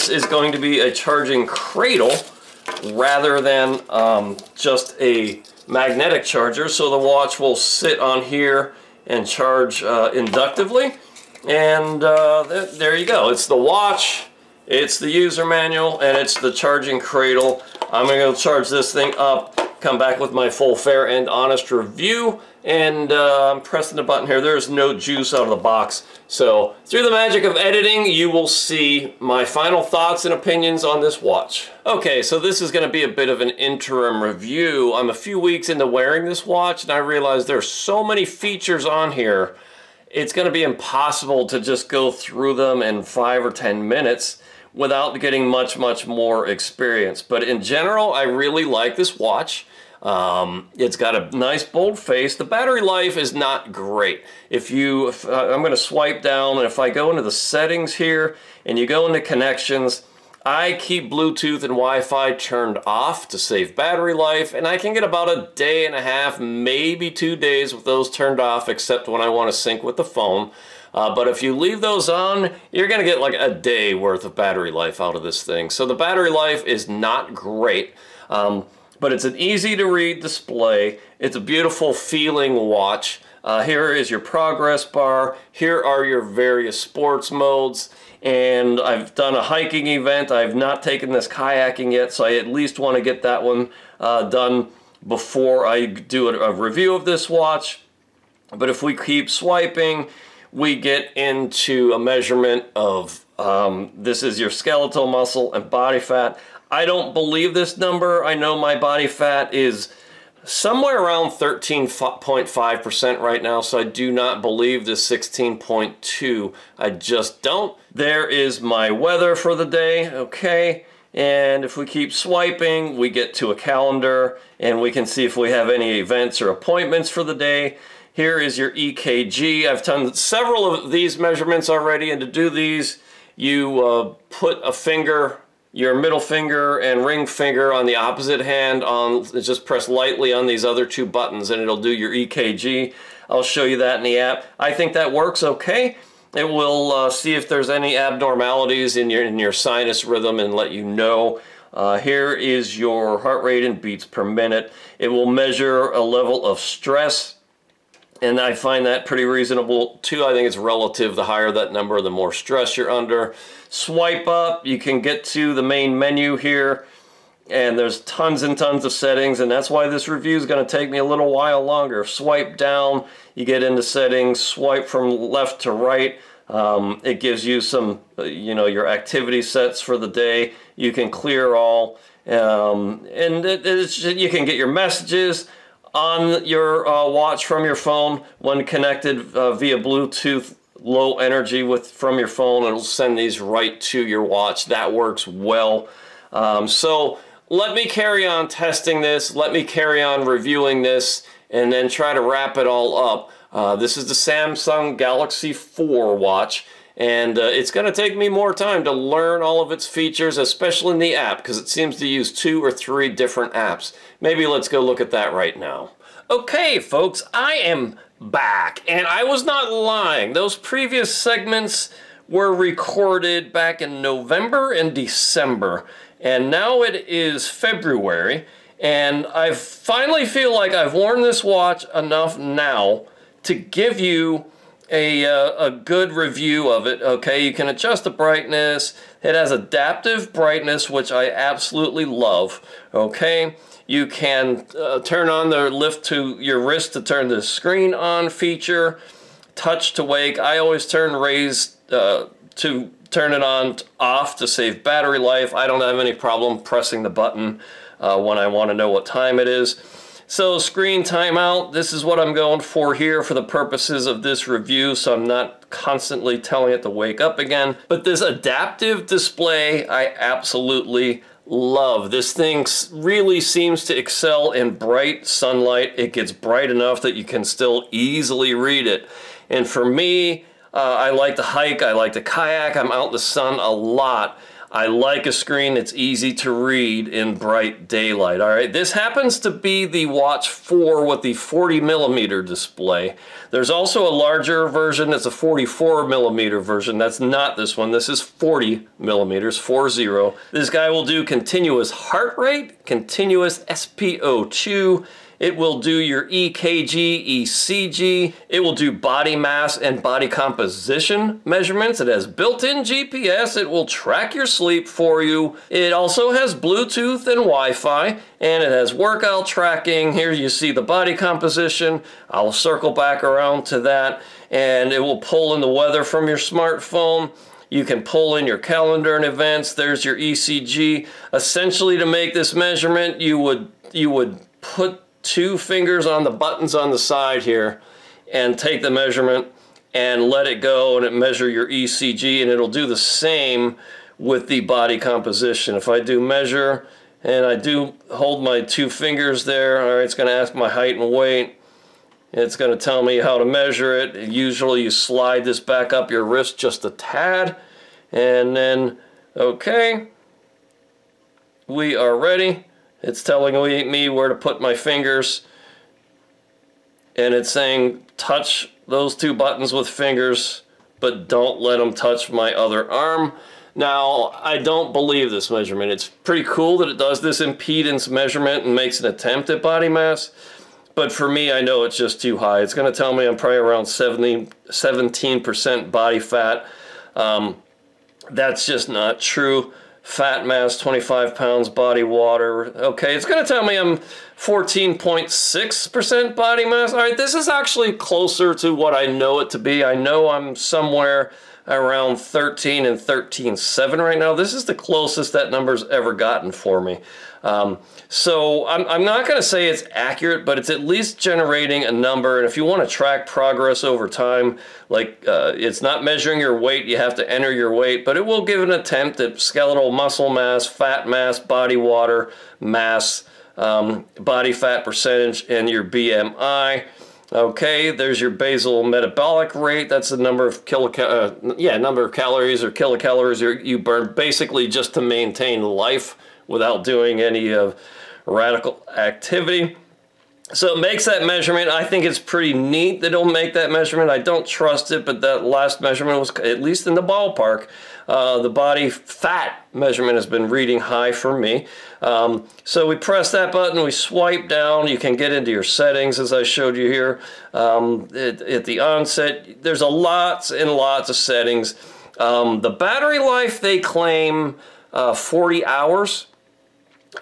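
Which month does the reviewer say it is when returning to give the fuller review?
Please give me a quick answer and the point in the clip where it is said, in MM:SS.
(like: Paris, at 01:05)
February, at 03:47.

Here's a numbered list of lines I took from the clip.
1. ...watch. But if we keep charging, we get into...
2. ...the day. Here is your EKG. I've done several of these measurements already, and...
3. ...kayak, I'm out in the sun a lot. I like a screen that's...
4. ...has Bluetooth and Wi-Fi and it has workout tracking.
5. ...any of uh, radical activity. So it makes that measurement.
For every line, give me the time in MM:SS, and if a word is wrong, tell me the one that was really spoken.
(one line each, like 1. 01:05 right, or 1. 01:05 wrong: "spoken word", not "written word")
1. 01:37 wrong: "swiping", not "charging"
2. 02:07 right
3. 04:42 right
4. 05:16 right
5. 07:17 right.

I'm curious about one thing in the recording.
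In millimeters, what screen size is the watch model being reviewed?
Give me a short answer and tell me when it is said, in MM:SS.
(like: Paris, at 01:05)
40 millimeters, at 04:51.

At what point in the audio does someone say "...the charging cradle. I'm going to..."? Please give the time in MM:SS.
00:16.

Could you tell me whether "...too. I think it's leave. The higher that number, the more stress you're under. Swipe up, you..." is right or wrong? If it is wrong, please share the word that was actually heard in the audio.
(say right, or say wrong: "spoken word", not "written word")
wrong: "relative", not "leave".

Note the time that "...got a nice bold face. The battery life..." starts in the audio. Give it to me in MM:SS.
00:50.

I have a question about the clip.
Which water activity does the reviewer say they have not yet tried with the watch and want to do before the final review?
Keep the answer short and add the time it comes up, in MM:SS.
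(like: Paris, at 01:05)
kayaking, at 01:31.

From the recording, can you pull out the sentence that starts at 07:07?
Okay, there's your basal metabolic rate.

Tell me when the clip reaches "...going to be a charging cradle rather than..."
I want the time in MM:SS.
00:00.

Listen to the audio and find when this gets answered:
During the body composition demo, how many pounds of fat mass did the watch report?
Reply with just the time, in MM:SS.
06:30.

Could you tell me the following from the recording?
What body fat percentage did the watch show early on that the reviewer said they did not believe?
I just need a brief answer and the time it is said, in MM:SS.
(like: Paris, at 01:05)
16.2, at 01:54.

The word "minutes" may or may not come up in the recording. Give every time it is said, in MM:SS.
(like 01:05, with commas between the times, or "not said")
00:43, 02:34.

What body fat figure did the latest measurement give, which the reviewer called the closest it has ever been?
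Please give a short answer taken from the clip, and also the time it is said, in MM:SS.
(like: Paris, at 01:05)
14.6%, at 06:34.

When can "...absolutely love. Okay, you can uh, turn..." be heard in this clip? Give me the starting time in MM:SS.
04:01.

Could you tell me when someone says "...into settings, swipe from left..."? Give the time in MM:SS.
02:53.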